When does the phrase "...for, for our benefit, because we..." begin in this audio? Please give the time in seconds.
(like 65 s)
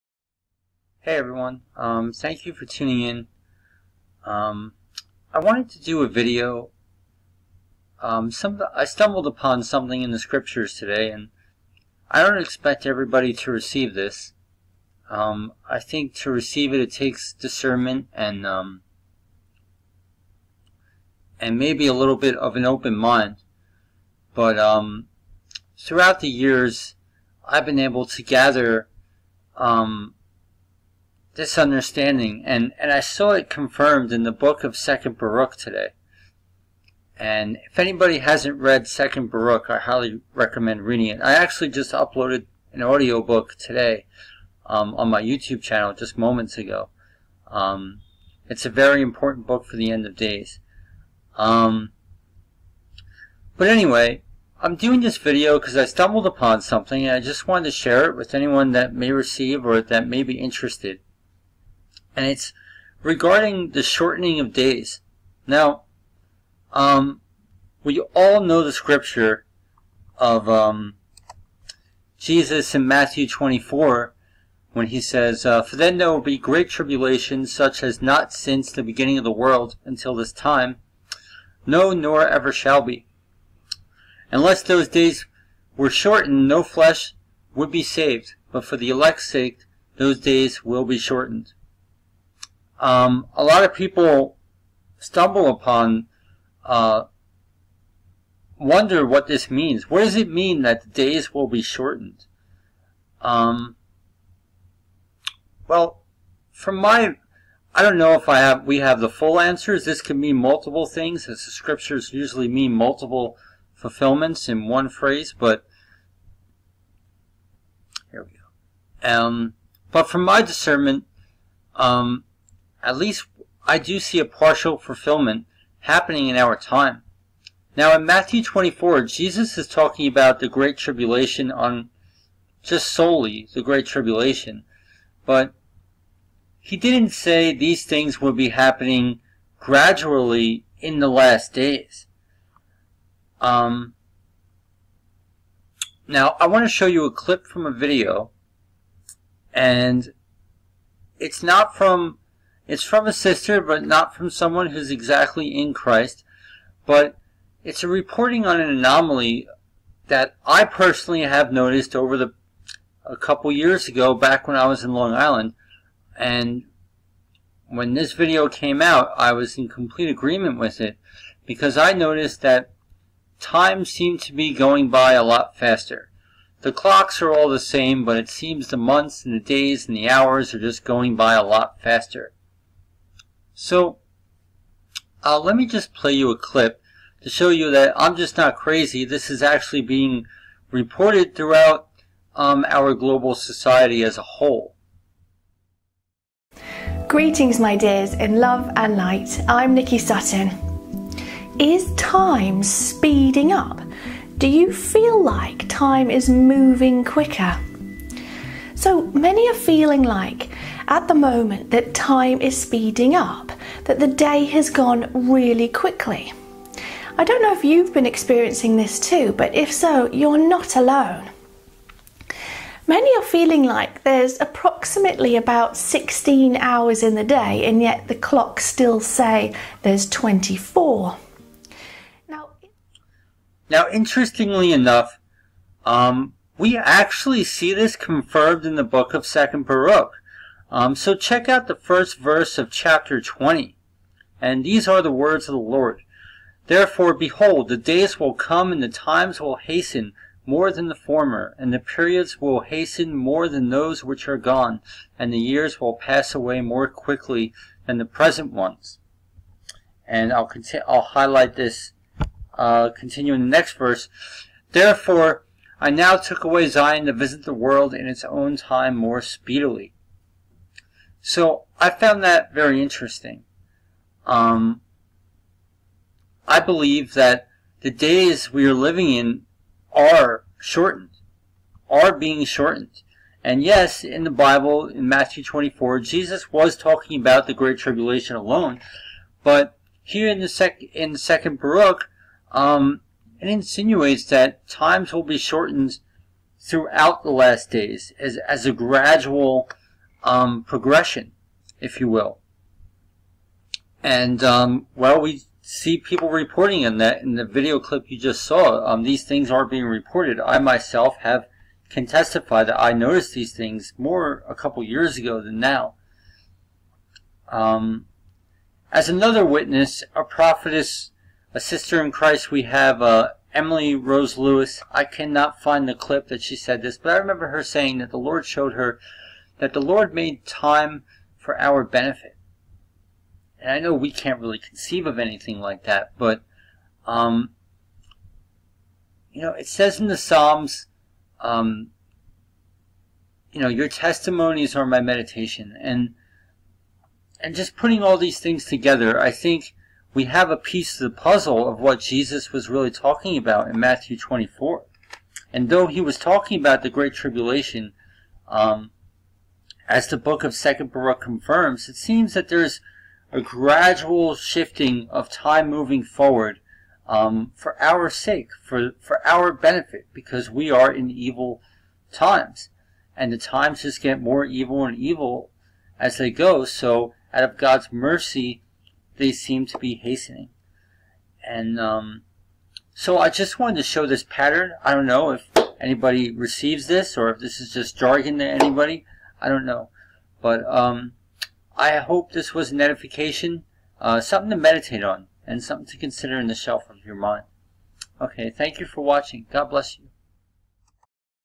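368 s.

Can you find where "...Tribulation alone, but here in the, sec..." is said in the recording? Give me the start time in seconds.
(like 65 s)
287 s.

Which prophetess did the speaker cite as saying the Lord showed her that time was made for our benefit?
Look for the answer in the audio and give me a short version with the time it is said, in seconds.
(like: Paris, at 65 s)
Emily Rose Lewis, at 323 s.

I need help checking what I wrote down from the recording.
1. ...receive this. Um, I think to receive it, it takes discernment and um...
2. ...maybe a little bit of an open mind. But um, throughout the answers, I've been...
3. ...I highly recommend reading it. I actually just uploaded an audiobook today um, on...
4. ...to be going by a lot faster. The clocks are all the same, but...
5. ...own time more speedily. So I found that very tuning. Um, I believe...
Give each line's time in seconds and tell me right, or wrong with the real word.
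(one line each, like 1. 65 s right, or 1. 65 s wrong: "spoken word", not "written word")
1. 13 s right
2. 21 s wrong: "years", not "answers"
3. 39 s right
4. 174 s right
5. 268 s wrong: "interesting", not "tuning".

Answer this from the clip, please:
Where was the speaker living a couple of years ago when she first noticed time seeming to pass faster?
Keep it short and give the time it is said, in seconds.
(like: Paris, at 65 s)
Long Island, at 164 s.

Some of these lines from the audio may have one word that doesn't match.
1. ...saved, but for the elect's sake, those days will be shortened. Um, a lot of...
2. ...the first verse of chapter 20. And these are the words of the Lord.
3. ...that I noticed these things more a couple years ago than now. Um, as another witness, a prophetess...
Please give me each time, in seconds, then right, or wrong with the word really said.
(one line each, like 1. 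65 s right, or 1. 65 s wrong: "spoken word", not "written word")
1. 87 s right
2. 241 s right
3. 312 s right.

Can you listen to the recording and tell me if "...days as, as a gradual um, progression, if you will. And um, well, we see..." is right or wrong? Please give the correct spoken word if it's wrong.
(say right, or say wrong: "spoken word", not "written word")
right.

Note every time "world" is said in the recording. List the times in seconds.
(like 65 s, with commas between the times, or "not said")
79 s, 267 s.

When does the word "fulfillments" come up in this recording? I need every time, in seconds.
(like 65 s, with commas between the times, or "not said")
113 s, 124 s.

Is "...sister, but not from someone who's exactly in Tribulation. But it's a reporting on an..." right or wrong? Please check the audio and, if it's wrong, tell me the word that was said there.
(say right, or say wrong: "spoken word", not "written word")
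wrong: "Christ", not "Tribulation".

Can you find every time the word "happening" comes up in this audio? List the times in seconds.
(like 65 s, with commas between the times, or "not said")
125 s, 138 s.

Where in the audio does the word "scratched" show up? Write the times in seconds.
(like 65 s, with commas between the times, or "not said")
not said.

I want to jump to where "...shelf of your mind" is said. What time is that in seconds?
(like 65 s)
396 s.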